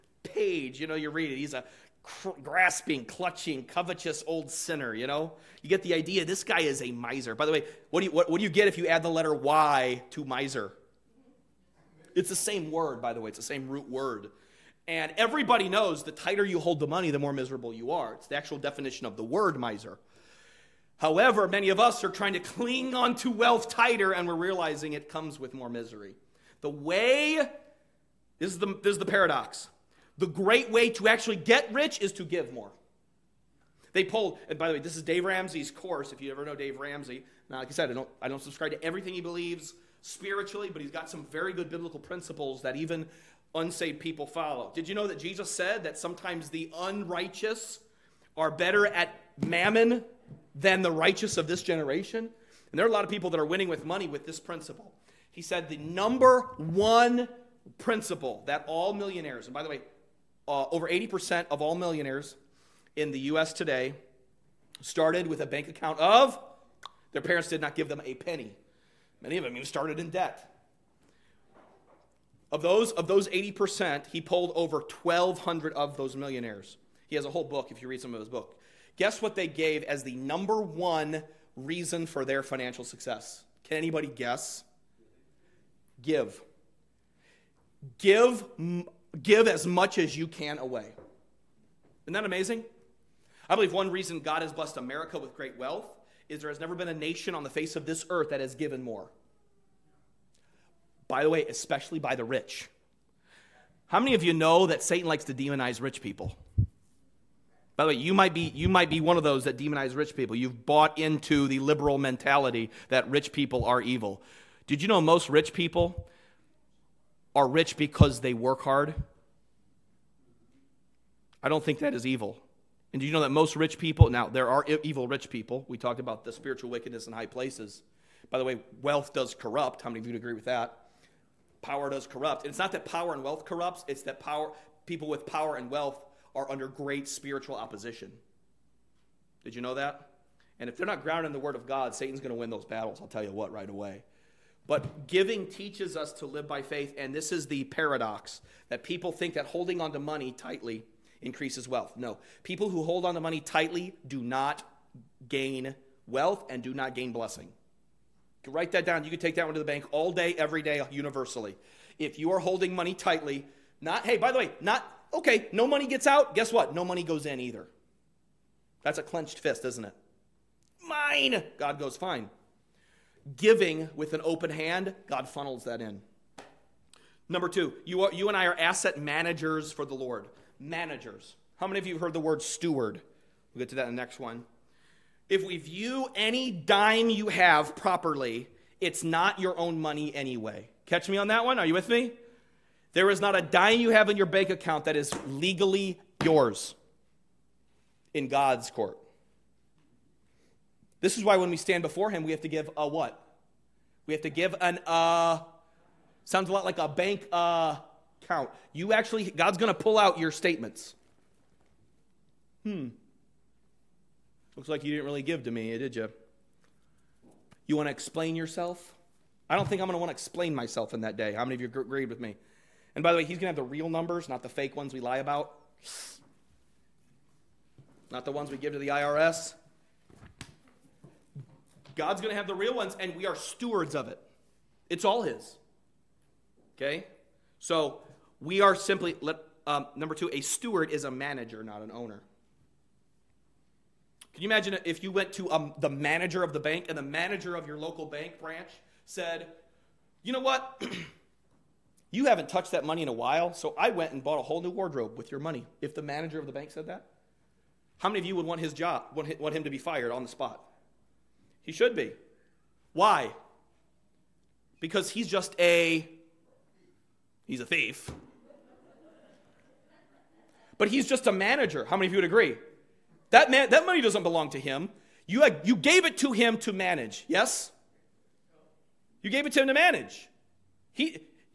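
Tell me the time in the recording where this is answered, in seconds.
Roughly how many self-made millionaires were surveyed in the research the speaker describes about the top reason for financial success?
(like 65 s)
75 s.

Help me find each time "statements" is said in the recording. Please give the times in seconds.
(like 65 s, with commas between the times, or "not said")
210 s.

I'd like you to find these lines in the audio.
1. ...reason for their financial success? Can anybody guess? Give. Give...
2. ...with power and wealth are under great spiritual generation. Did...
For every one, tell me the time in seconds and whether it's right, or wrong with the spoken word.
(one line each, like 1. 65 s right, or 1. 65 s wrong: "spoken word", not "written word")
1. 81 s right
2. 135 s wrong: "opposition", not "generation".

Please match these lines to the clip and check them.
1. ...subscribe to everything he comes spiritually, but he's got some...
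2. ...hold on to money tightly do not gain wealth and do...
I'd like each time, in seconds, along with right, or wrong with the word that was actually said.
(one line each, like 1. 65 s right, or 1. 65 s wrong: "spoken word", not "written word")
1. 38 s wrong: "believes", not "comes"
2. 152 s right.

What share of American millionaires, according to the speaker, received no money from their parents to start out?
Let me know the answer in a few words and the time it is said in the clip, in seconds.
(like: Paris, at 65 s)
over 80%, at 60 s.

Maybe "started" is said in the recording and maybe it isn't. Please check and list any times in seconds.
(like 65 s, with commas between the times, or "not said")
64 s, 69 s.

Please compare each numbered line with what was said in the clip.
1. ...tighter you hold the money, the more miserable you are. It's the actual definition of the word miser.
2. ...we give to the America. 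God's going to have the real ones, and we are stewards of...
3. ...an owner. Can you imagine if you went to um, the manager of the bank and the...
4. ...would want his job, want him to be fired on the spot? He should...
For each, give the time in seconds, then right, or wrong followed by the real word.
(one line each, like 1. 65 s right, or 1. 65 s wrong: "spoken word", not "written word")
1. 16 s right
2. 228 s wrong: "IRS", not "America"
3. 241 s right
4. 258 s right.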